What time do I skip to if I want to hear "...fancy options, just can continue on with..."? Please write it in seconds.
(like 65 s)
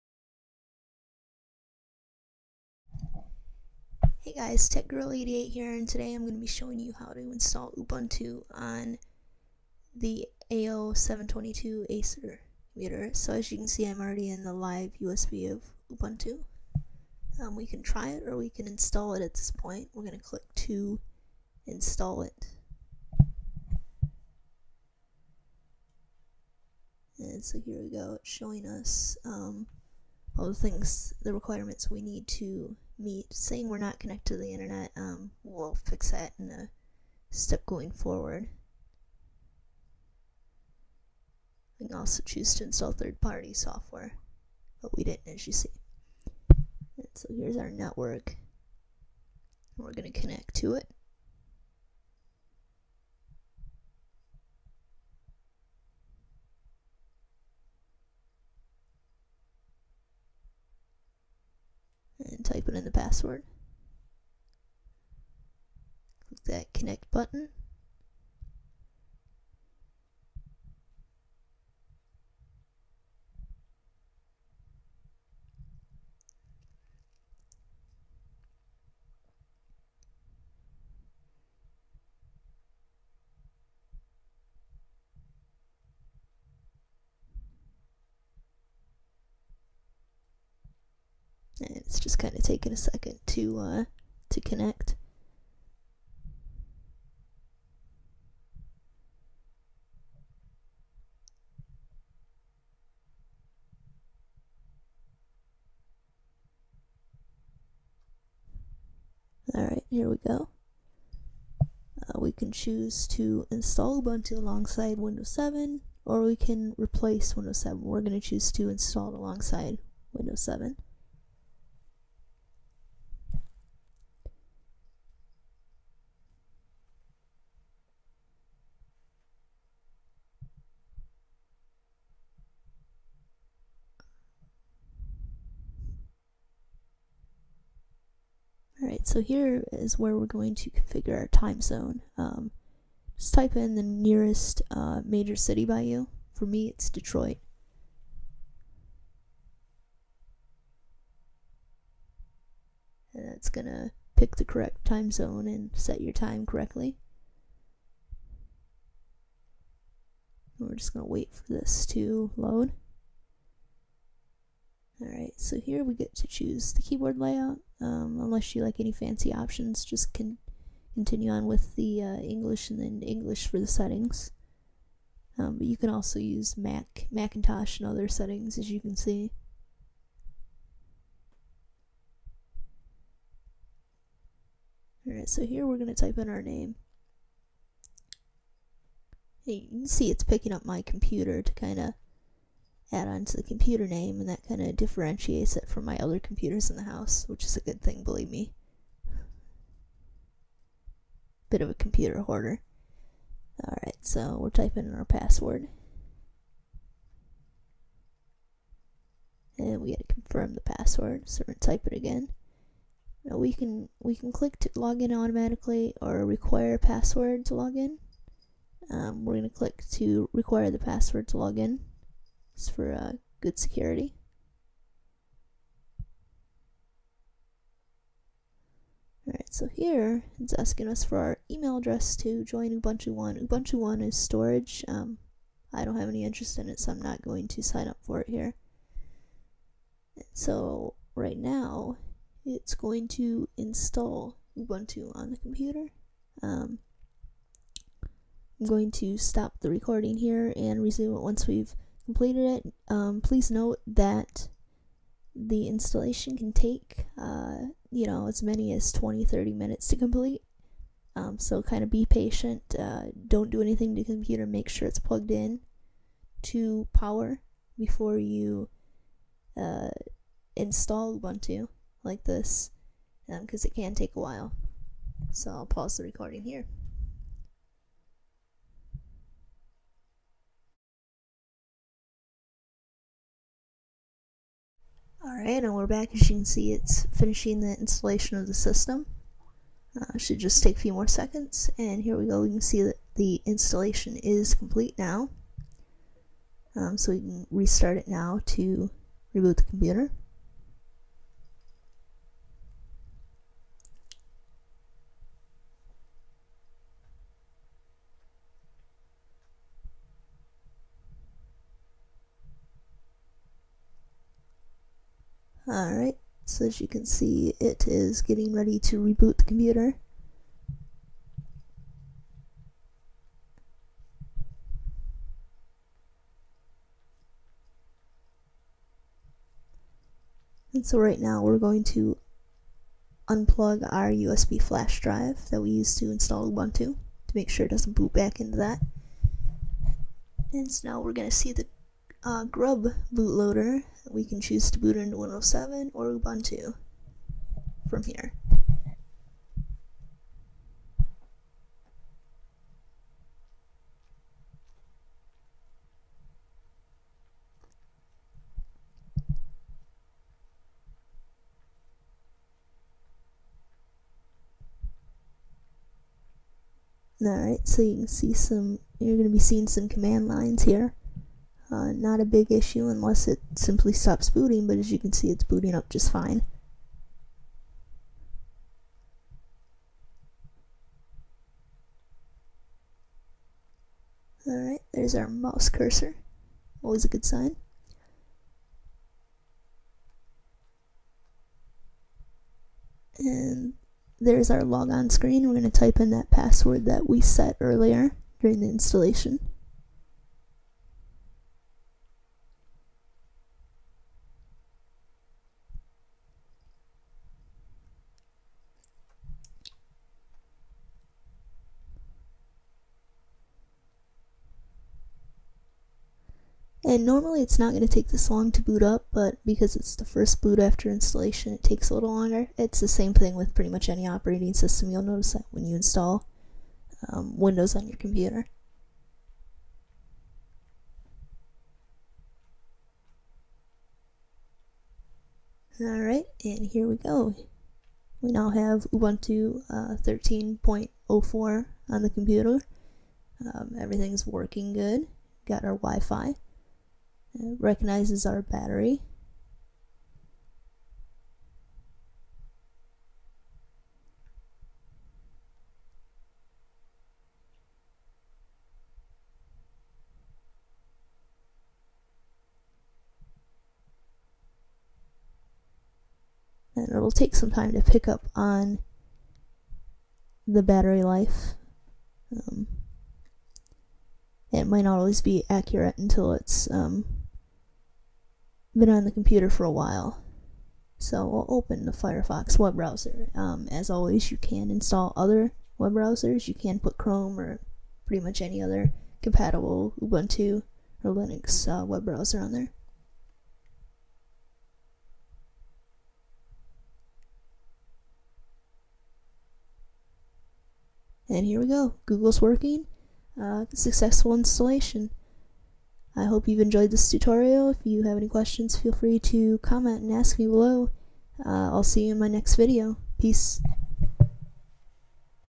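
168 s.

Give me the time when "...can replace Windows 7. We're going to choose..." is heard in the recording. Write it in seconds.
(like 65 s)
116 s.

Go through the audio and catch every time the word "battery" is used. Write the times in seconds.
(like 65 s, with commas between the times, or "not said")
448 s, 470 s.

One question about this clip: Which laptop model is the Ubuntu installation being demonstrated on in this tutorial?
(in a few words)
Acer AO722.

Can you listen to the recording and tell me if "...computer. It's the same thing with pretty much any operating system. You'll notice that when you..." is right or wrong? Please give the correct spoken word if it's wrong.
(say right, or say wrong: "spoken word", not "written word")
wrong: "longer", not "computer".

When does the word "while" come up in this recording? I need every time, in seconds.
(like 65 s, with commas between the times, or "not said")
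274 s, 479 s.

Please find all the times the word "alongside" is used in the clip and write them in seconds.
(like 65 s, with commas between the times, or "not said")
114 s, 119 s.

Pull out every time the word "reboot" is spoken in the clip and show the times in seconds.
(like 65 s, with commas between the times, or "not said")
299 s, 318 s.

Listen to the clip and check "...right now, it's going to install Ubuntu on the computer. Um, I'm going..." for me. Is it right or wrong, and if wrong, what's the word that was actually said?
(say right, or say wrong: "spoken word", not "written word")
right.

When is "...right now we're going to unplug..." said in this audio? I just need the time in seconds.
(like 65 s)
330 s.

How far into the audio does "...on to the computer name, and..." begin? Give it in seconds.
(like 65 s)
193 s.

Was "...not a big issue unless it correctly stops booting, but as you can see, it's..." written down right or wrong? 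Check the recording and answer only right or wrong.
wrong.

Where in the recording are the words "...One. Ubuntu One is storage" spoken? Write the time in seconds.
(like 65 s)
233 s.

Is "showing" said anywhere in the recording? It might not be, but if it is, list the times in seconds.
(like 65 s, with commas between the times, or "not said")
6 s, 28 s.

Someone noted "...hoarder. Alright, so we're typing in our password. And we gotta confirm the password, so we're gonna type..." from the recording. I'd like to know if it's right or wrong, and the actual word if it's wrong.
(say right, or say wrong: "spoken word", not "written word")
right.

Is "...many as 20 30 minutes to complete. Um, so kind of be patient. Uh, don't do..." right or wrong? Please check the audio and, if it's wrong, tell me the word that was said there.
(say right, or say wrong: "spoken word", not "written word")
right.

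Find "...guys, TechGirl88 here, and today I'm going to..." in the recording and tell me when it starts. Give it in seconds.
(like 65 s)
4 s.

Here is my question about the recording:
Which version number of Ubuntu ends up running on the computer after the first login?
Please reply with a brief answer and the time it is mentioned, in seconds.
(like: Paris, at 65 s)
13.04, at 439 s.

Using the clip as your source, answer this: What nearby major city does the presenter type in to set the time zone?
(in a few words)
Detroit.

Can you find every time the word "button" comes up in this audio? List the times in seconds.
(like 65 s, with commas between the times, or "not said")
67 s.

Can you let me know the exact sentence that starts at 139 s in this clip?
So here is where we're going to configure our time zone.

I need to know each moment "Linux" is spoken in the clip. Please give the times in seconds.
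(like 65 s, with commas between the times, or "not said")
491 s.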